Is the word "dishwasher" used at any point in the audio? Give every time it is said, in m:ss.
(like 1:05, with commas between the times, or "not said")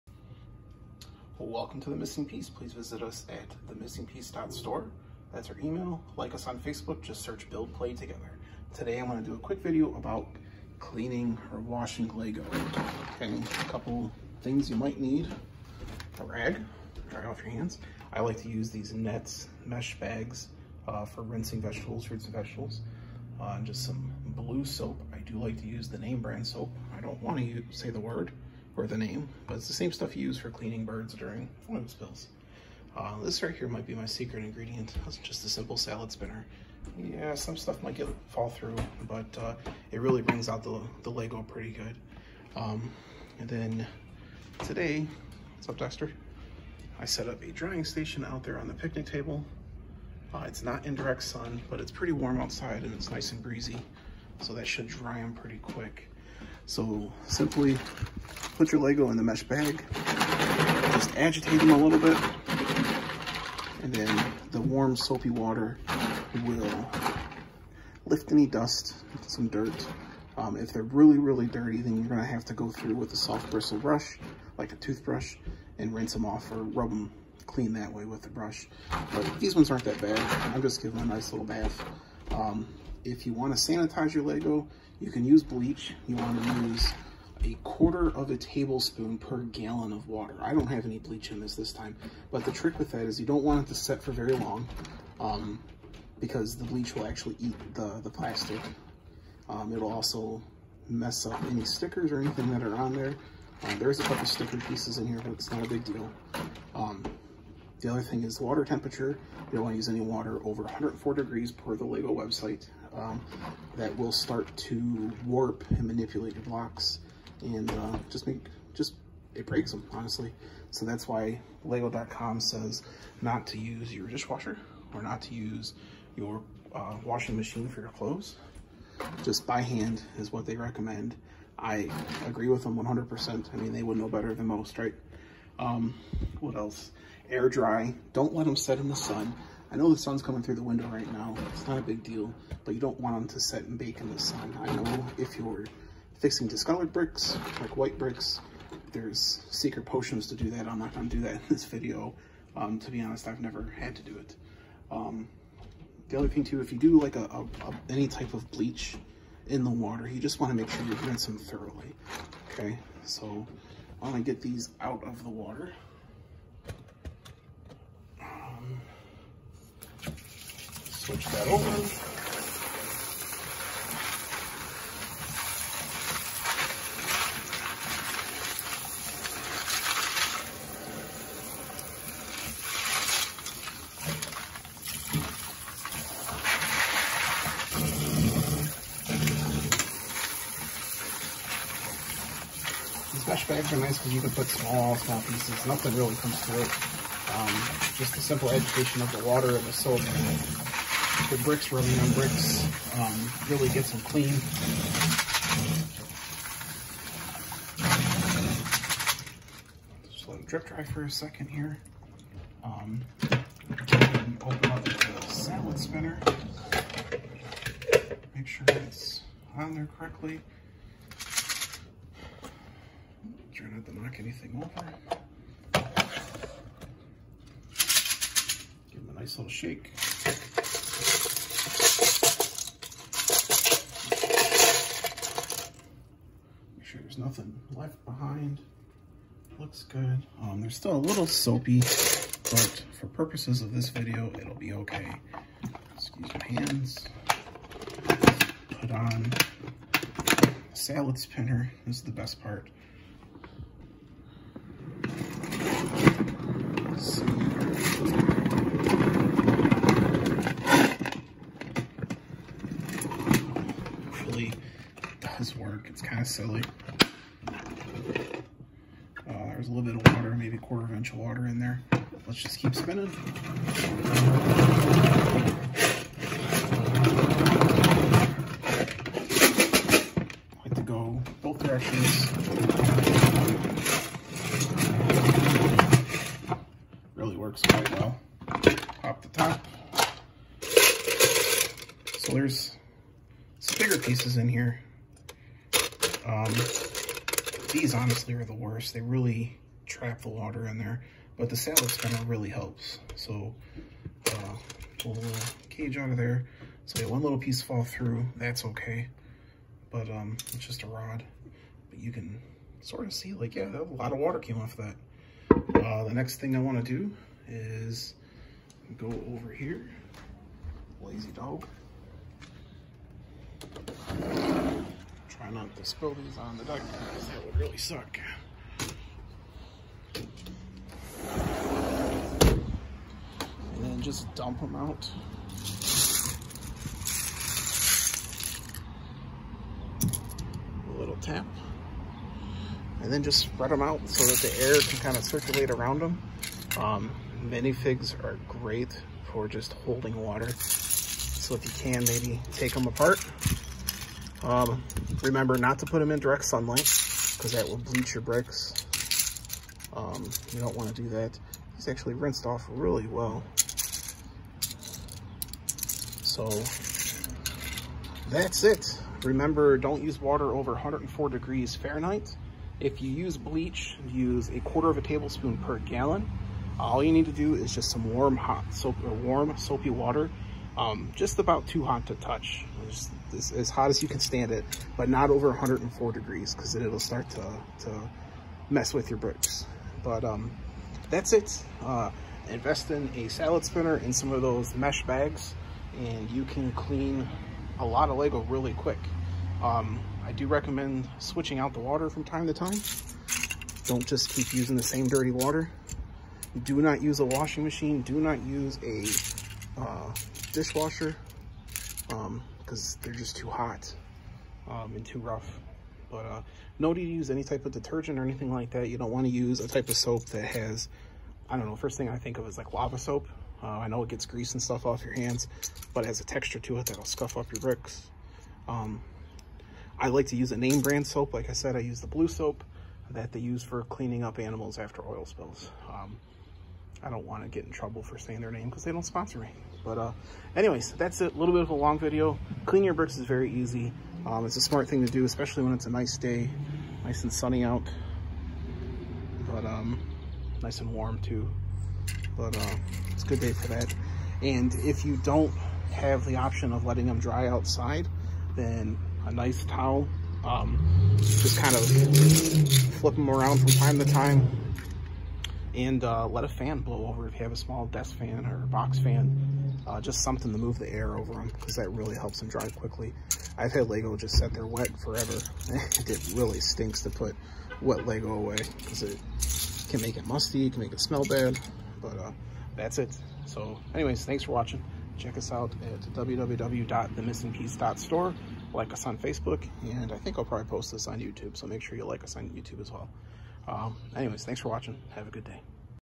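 2:04, 6:50.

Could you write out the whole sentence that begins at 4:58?
They really trap the water in there, but the salad spinner really helps.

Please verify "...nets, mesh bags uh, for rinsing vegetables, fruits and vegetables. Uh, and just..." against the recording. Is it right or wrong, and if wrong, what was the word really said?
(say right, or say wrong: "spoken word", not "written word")
right.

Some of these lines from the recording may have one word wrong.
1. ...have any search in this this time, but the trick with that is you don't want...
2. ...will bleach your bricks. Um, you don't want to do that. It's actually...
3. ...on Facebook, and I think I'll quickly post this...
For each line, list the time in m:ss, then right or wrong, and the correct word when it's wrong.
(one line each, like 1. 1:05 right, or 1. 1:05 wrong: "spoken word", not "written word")
1. 1:30 wrong: "bleach", not "search"
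2. 5:57 right
3. 8:09 wrong: "probably", not "quickly".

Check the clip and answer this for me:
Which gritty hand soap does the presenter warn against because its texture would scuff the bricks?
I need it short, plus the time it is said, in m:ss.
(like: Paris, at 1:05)
lava soap, at 7:02.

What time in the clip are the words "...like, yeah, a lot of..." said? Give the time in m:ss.
5:13.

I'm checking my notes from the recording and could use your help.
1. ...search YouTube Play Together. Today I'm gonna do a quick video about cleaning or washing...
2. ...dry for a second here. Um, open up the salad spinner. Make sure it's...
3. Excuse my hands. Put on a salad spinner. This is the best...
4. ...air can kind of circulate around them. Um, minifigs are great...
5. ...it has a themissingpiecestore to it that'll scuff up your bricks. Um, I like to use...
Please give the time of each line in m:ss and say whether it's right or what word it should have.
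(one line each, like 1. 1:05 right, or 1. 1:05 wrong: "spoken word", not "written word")
1. 0:07 wrong: "Build", not "YouTube"
2. 3:30 right
3. 4:05 right
4. 5:44 right
5. 7:06 wrong: "texture", not "themissingpiecestore".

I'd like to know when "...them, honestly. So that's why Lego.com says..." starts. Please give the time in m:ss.
1:59.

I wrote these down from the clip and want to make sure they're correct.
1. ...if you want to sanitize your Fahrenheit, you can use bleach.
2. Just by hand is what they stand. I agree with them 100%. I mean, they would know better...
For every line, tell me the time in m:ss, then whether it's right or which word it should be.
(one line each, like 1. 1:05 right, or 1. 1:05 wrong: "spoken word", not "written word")
1. 1:23 wrong: "Lego", not "Fahrenheit"
2. 2:09 wrong: "recommend", not "stand".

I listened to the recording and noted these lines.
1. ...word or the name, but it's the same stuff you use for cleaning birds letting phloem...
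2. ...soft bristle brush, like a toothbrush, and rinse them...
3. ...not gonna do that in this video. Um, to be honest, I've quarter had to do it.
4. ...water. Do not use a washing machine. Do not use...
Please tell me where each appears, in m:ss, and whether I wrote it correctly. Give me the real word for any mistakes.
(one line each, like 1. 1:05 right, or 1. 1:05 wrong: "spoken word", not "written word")
1. 0:27 wrong: "during", not "letting"
2. 1:13 right
3. 2:30 wrong: "never", not "quarter"
4. 6:45 right.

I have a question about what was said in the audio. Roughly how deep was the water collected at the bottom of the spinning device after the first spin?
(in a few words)
a quarter of an inch.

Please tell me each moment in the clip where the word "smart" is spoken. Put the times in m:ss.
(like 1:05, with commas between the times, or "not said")
7:24.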